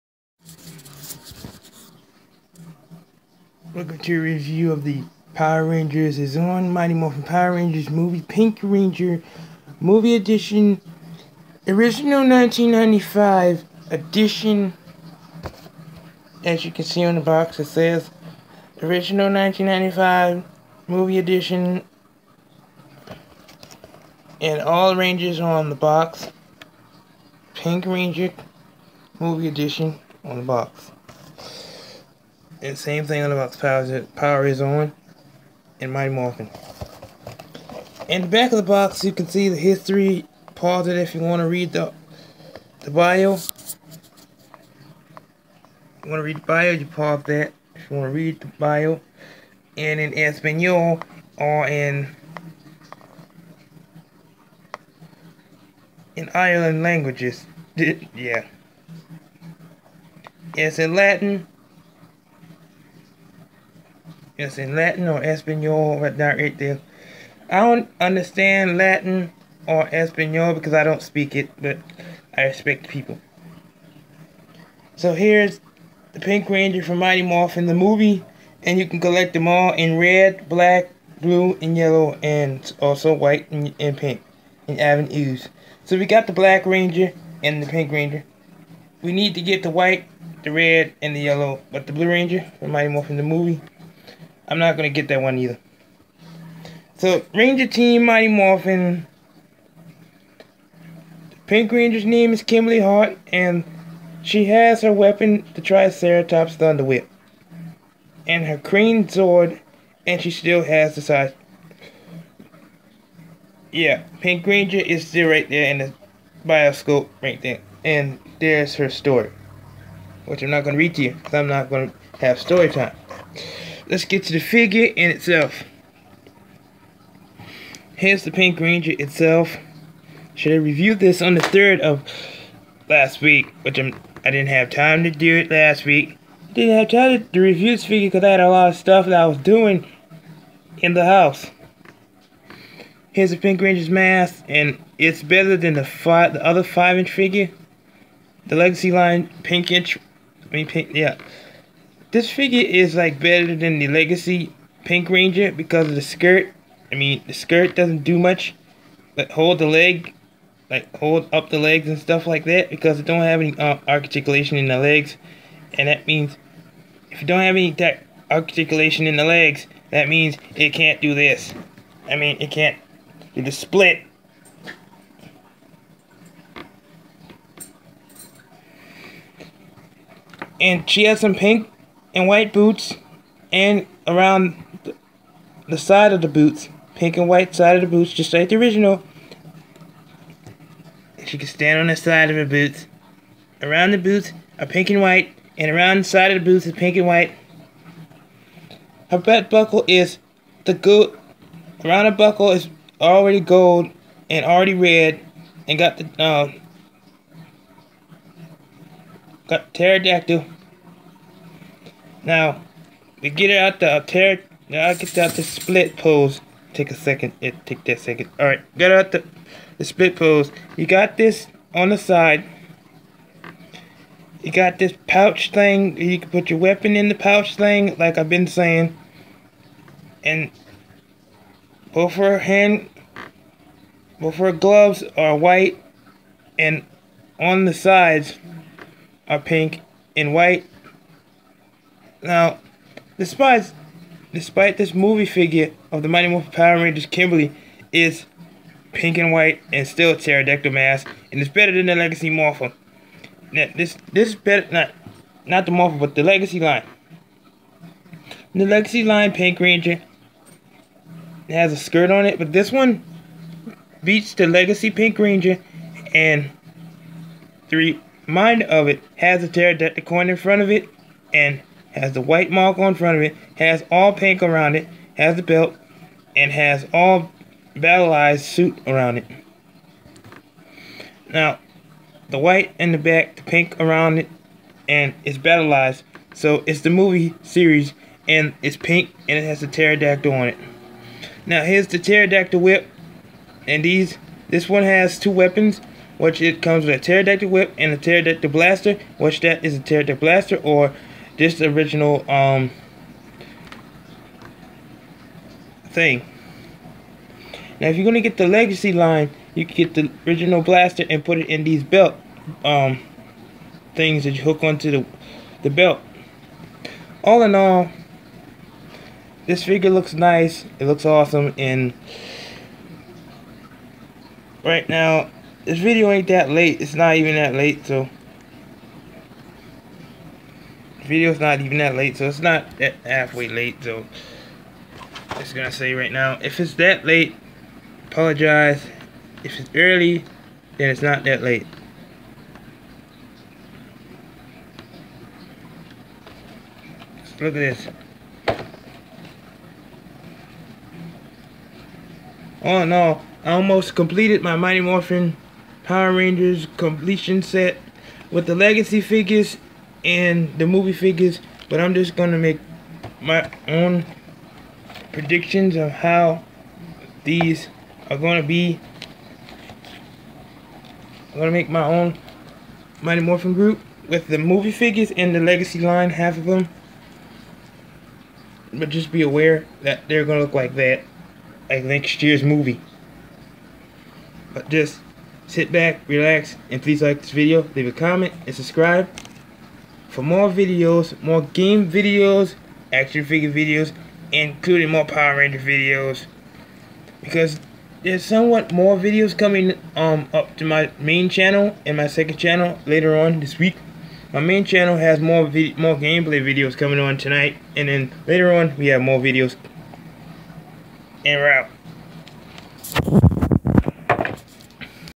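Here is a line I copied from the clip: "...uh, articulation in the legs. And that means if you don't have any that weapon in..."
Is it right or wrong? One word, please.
wrong.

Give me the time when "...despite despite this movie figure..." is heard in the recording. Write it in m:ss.
4:03.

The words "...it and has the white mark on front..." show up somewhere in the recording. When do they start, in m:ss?
4:30.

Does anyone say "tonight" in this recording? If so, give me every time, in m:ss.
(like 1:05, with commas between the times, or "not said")
6:47.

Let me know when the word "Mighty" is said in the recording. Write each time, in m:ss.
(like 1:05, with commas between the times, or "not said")
0:06, 0:35, 1:16, 1:32, 1:38, 4:06, 5:54, 6:13.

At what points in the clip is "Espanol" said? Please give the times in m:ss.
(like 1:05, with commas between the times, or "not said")
0:50, 1:05, 1:09.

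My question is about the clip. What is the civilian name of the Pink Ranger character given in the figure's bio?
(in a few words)
Kimberly Hart.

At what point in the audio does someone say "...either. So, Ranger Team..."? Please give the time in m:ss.
1:35.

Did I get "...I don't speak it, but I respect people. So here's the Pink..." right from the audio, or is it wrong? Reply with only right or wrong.
right.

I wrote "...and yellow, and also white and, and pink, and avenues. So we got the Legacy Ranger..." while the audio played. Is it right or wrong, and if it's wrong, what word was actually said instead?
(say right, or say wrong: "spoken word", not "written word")
wrong: "Black", not "Legacy".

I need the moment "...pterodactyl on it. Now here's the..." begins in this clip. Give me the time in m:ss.
4:49.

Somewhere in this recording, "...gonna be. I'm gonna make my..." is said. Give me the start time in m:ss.
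6:08.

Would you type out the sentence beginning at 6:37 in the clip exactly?
Because there's somewhat more videos coming um, up to my main channel and my second channel later on this week.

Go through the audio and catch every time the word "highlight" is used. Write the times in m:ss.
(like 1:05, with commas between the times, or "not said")
not said.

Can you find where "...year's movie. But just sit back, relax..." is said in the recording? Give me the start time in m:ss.
6:22.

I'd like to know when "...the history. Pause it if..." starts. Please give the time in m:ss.
0:39.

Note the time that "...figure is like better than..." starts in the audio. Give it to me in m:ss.
2:32.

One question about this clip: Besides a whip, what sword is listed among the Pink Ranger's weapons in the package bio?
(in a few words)
Crane Sword.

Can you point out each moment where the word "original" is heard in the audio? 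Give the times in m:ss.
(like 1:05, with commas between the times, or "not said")
0:11, 0:18, 3:08, 5:01, 5:10.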